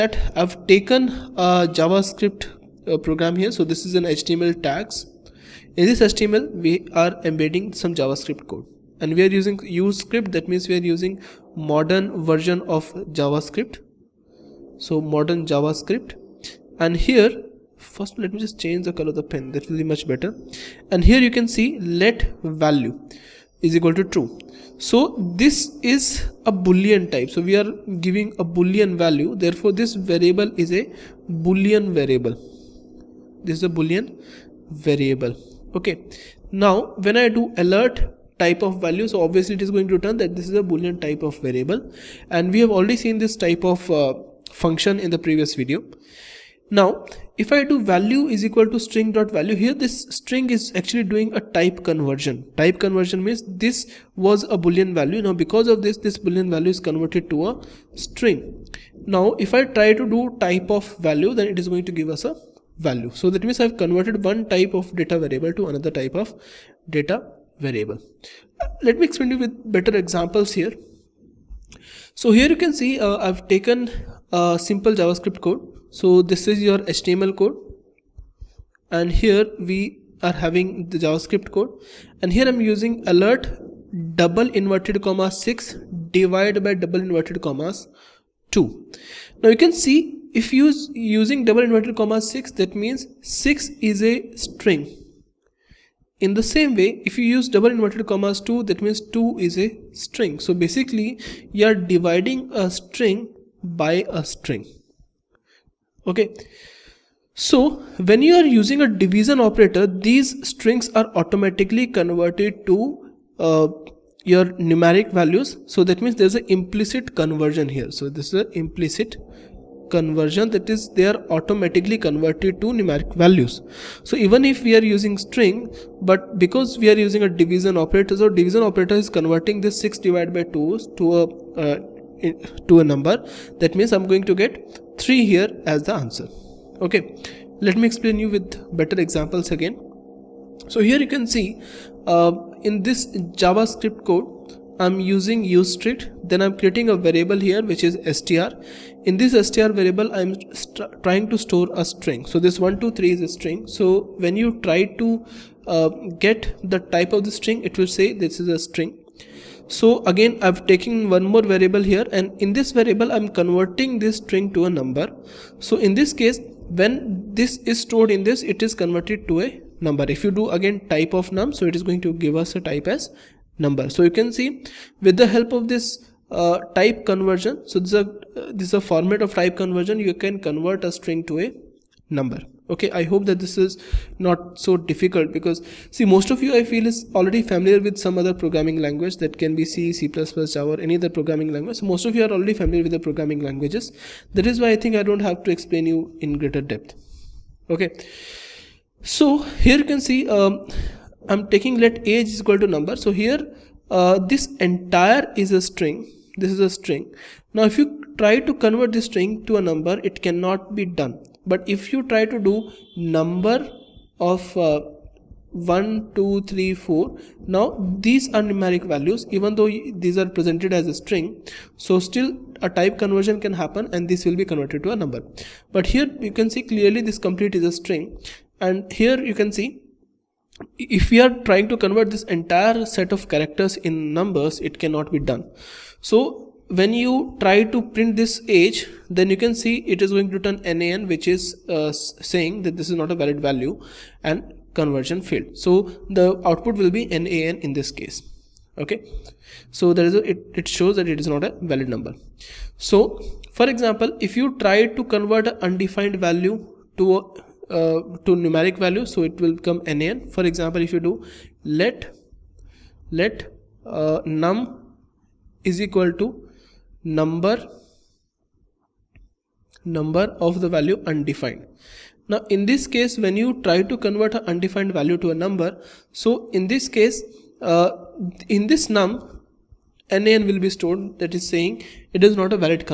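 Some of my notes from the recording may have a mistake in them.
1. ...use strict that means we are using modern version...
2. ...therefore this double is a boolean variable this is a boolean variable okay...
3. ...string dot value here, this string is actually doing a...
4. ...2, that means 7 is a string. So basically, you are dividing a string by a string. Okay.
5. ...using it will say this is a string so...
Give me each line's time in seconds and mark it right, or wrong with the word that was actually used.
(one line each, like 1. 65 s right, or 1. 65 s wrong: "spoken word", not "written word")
1. 9 s right
2. 29 s wrong: "variable", not "double"
3. 48 s right
4. 98 s wrong: "2", not "7"
5. 157 s wrong: "string", not "using".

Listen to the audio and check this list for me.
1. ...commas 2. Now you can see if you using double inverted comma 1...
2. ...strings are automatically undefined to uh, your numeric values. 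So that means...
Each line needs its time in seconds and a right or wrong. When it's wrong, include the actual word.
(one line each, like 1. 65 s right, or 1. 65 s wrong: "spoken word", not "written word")
1. 87 s wrong: "6", not "1"
2. 110 s wrong: "converted", not "undefined".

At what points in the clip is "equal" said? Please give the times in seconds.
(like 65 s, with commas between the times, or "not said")
23 s, 48 s, 202 s, 265 s.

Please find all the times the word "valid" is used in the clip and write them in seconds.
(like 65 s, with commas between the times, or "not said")
243 s, 251 s.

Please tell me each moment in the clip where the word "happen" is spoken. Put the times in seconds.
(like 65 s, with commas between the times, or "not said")
223 s.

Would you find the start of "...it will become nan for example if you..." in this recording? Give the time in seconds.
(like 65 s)
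259 s.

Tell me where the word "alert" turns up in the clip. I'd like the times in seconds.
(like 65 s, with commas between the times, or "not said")
37 s, 83 s.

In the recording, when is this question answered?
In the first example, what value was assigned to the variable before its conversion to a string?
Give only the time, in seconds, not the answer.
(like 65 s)
24 s.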